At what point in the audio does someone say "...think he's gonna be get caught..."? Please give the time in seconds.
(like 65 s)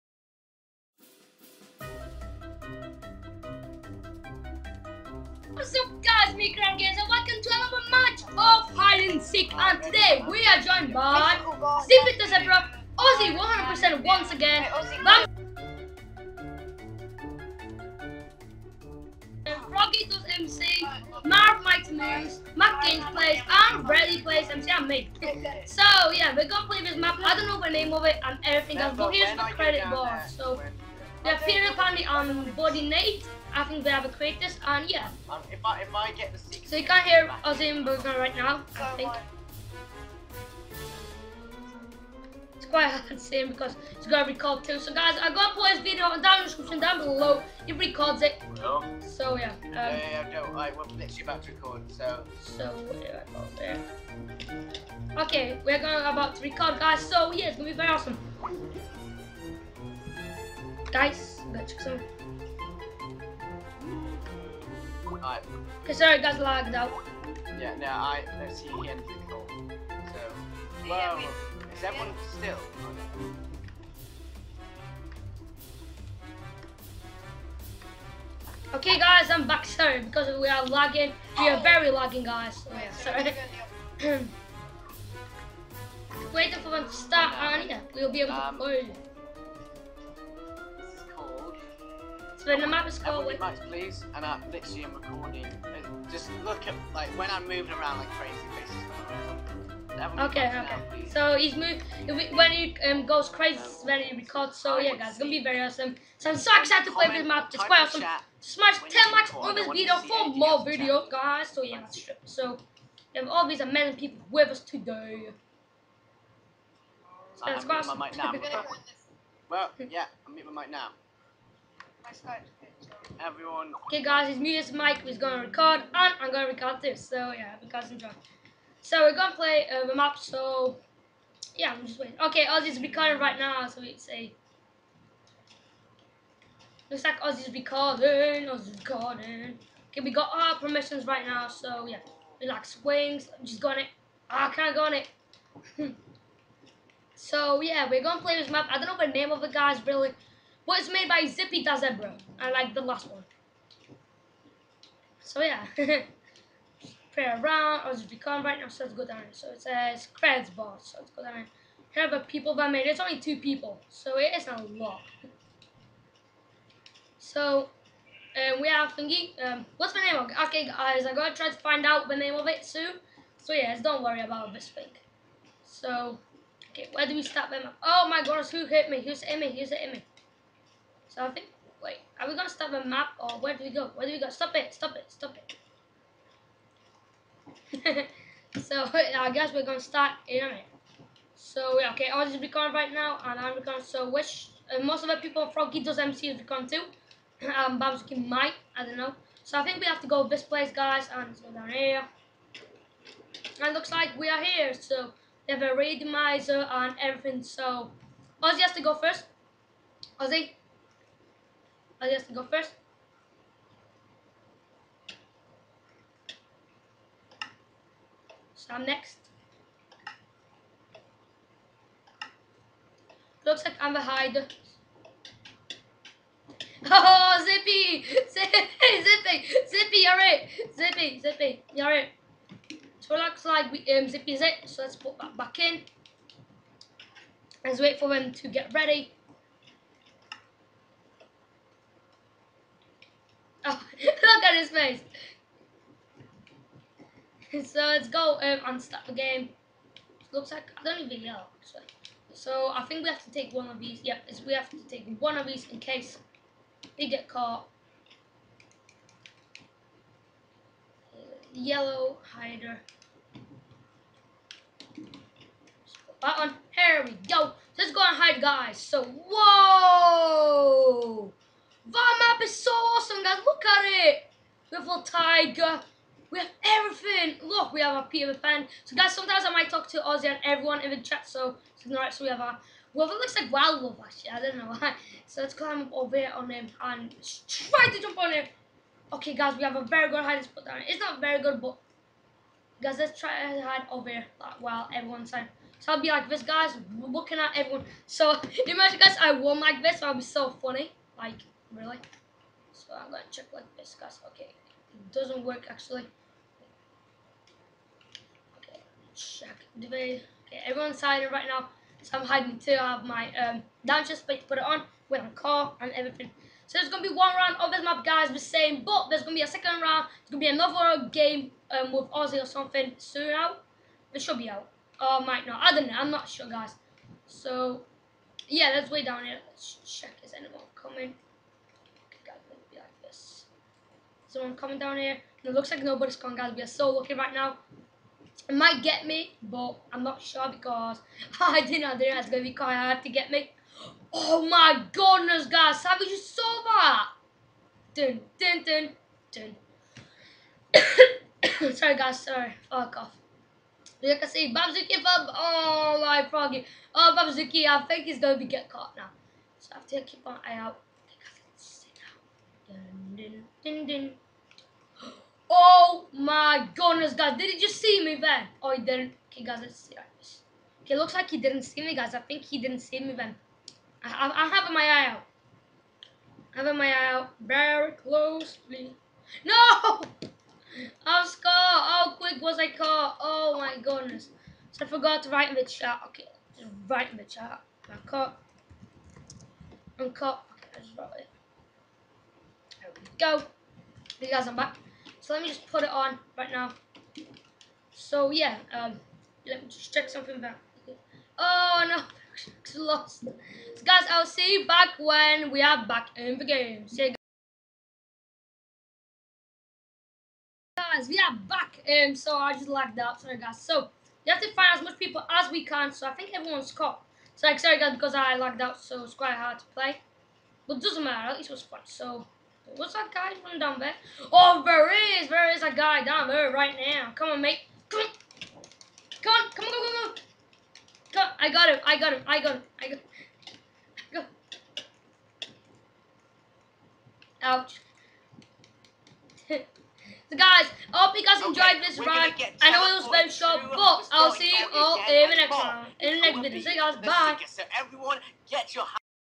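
357 s.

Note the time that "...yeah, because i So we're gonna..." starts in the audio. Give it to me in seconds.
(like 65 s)
127 s.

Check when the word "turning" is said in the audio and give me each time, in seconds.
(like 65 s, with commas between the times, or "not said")
not said.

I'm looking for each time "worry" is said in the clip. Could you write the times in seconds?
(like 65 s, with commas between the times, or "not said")
174 s.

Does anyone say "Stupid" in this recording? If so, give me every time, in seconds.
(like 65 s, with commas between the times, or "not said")
11 s.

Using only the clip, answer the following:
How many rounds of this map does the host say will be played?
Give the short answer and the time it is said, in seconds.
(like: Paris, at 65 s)
1, at 316 s.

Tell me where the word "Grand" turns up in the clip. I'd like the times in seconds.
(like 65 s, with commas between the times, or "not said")
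6 s.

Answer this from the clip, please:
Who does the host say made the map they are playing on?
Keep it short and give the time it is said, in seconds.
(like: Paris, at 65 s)
Zippy the Zebra, at 150 s.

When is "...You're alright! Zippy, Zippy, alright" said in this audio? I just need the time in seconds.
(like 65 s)
229 s.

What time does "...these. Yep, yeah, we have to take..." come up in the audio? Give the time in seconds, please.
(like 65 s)
253 s.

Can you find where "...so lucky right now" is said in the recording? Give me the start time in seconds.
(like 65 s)
336 s.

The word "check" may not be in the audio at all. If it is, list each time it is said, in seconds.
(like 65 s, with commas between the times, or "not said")
303 s, 309 s, 329 s, 399 s.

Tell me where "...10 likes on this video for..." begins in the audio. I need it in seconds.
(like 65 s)
108 s.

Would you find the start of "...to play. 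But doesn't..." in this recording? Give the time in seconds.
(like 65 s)
419 s.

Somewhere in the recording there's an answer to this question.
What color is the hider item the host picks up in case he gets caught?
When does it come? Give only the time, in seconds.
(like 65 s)
261 s.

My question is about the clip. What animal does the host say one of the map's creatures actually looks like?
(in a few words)
wild wolf.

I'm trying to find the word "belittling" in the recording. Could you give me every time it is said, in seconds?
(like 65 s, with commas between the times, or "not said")
not said.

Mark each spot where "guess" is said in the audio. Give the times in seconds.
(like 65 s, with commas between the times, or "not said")
189 s, 212 s.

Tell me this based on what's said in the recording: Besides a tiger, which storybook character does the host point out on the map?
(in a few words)
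Peter Pan.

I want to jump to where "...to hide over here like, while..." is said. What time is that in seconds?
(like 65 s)
293 s.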